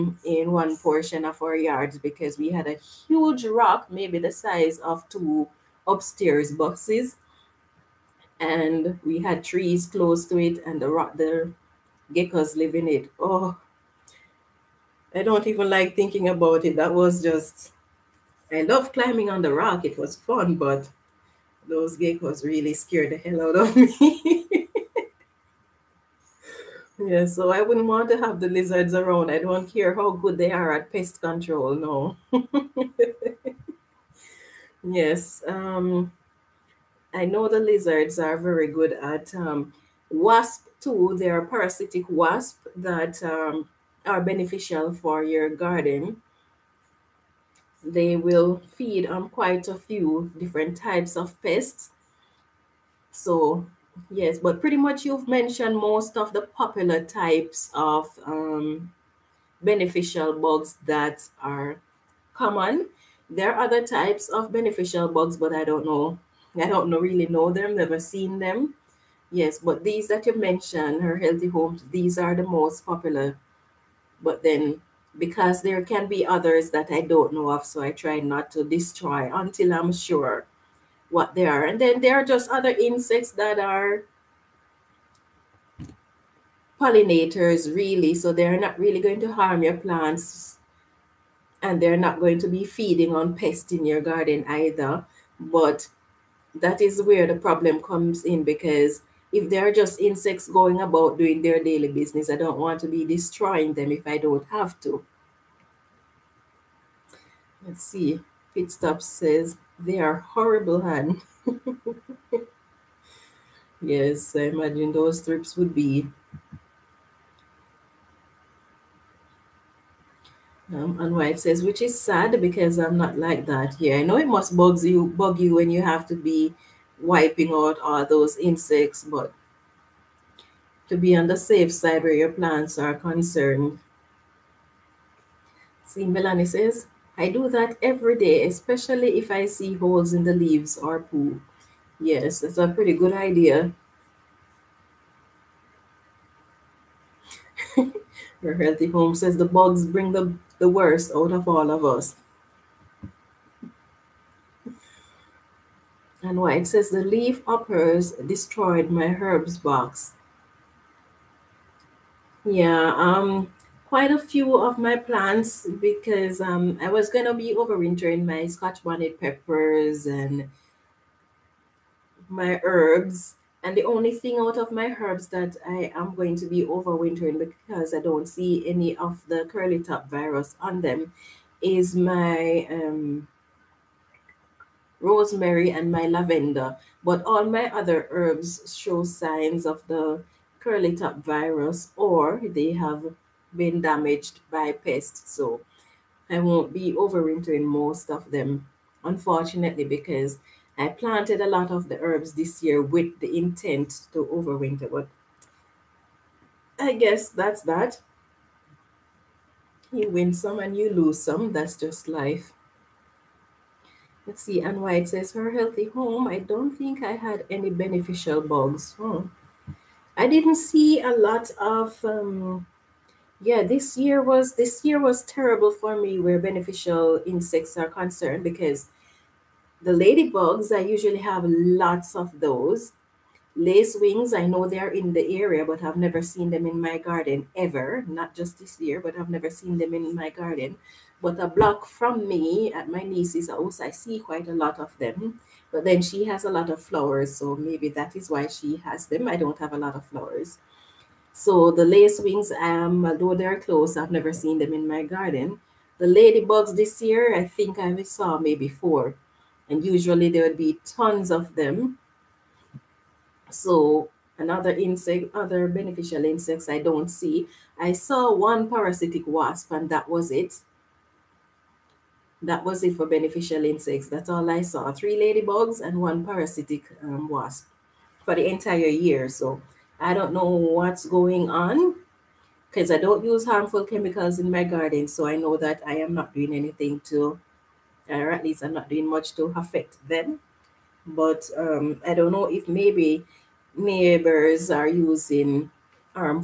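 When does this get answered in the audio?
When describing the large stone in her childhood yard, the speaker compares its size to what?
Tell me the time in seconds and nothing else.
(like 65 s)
5 s.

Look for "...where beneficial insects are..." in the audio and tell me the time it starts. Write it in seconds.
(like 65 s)
226 s.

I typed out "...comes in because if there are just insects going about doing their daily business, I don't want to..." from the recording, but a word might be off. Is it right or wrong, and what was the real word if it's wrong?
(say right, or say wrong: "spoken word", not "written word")
right.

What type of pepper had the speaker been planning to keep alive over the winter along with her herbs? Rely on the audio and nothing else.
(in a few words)
Scotch bonnet.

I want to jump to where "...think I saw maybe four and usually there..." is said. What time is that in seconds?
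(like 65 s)
257 s.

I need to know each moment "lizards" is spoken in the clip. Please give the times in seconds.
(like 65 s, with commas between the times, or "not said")
28 s, 37 s.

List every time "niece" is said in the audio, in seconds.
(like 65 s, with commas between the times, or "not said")
243 s.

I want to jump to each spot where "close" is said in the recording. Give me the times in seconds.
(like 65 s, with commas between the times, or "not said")
9 s, 253 s.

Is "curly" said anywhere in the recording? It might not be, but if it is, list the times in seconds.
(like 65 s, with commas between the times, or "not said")
179 s, 190 s.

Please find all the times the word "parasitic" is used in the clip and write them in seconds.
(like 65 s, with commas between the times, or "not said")
41 s, 268 s, 276 s.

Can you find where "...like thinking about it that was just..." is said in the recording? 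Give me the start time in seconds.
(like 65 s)
15 s.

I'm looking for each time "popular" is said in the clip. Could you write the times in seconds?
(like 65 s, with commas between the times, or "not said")
56 s, 72 s.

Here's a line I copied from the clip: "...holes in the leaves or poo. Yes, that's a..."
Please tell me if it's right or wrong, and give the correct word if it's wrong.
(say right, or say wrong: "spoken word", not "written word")
right.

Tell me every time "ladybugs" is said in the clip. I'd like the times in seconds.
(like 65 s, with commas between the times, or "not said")
229 s, 256 s, 275 s.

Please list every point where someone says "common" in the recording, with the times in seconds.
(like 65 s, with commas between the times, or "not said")
62 s.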